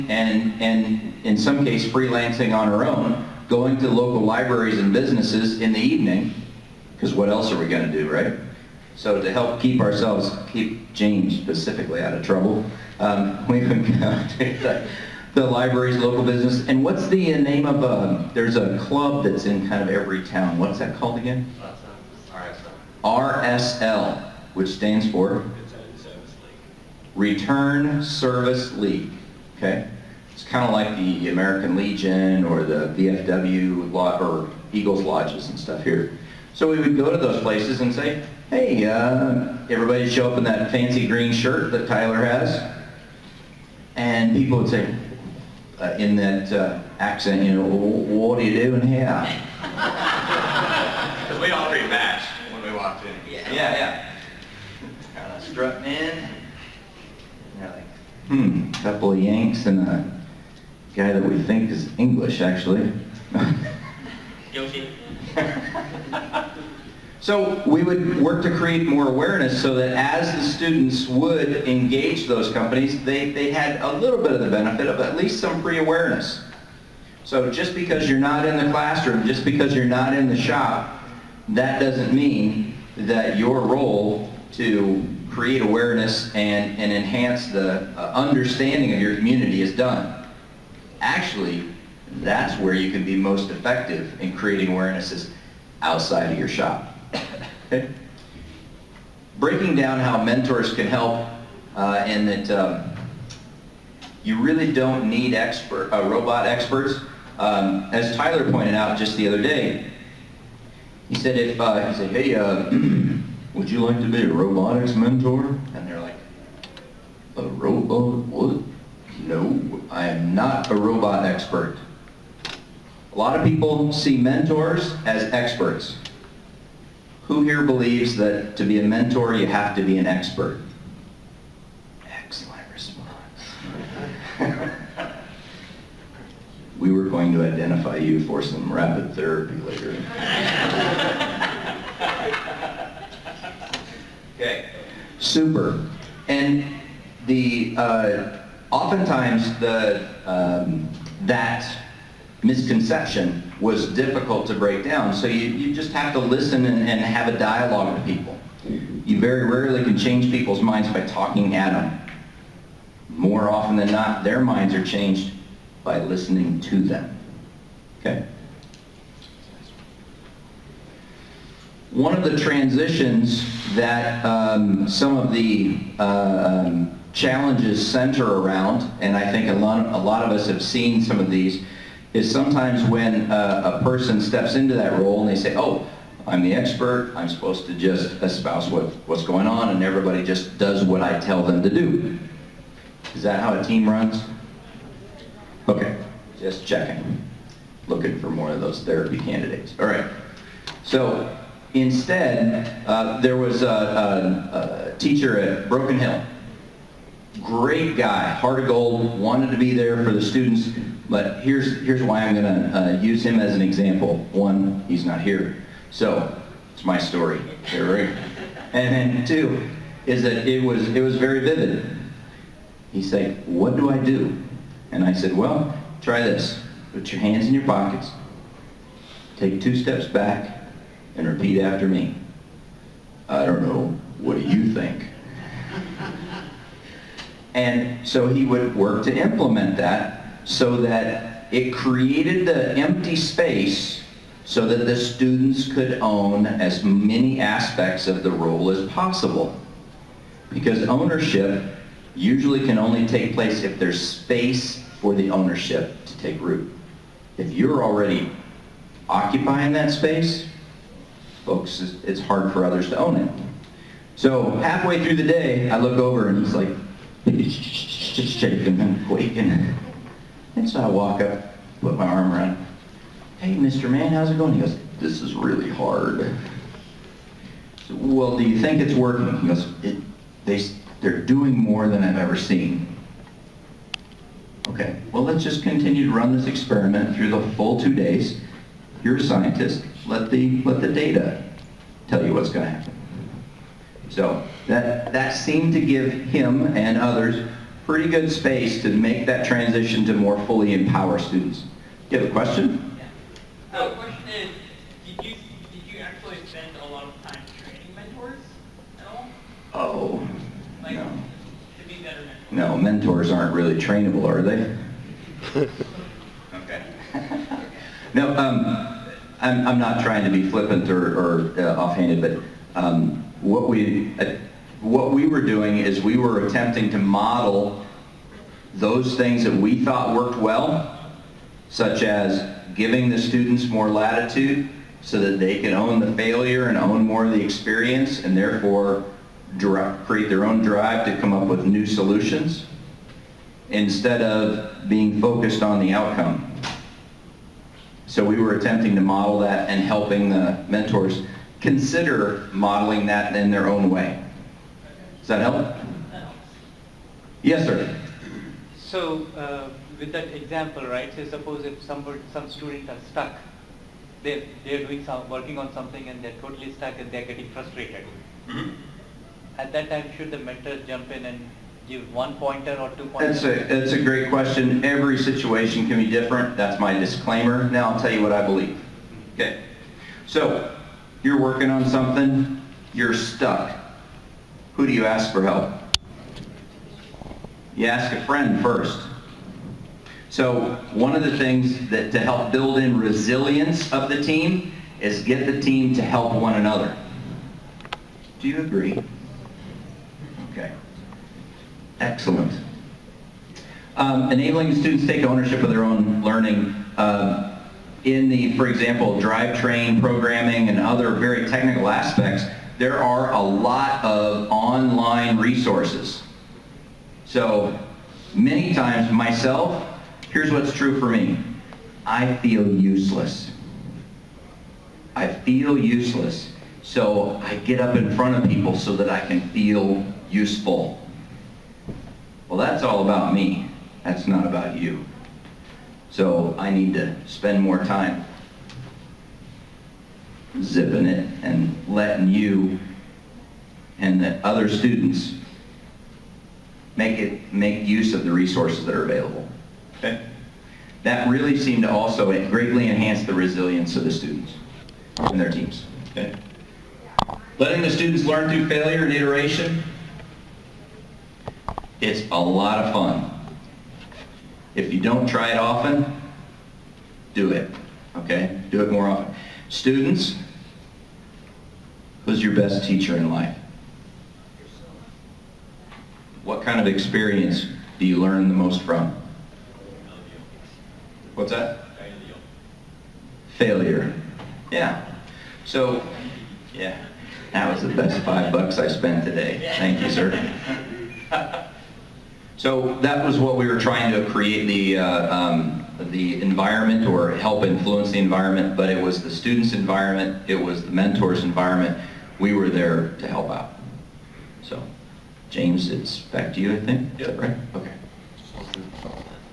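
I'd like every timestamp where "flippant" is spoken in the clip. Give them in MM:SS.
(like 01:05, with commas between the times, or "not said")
05:20.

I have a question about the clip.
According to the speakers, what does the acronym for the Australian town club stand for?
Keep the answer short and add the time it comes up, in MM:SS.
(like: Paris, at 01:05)
Return Service League, at 00:27.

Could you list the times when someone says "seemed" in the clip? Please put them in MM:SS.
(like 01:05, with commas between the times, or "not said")
04:55, 07:31.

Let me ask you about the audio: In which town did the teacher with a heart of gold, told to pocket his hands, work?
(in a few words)
Broken Hill.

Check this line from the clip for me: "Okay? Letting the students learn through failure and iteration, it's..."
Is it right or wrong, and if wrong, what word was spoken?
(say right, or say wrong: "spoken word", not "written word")
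right.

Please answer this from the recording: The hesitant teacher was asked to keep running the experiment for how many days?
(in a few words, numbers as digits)
2.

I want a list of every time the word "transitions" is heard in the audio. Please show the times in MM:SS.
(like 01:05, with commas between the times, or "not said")
02:52, 04:59.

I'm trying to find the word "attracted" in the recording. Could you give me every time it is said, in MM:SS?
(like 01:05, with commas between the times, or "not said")
not said.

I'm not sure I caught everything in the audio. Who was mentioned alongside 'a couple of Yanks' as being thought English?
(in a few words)
Yoshi.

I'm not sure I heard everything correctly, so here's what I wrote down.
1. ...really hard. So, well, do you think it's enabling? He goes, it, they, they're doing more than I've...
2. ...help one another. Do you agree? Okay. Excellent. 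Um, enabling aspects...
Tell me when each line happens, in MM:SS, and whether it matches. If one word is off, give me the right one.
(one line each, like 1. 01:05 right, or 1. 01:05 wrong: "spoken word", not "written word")
1. 04:35 wrong: "working", not "enabling"
2. 06:36 wrong: "students", not "aspects".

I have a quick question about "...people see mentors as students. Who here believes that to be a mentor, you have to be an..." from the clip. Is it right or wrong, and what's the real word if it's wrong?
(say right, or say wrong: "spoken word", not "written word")
wrong: "experts", not "students".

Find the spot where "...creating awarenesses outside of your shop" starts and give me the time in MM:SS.
01:34.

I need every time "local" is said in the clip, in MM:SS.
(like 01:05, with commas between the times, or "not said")
00:03, 00:15.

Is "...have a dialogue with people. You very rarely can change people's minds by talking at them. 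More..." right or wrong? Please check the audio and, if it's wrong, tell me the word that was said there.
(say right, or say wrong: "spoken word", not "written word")
right.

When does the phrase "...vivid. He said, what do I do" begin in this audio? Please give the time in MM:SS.
03:41.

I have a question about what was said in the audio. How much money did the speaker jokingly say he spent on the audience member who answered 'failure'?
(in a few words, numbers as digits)
5 bucks.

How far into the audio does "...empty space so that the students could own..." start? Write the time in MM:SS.
04:02.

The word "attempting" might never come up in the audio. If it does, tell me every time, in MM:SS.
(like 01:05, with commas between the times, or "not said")
05:26, 05:48.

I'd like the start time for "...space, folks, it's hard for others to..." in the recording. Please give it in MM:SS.
04:19.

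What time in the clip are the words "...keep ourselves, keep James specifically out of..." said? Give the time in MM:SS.
00:09.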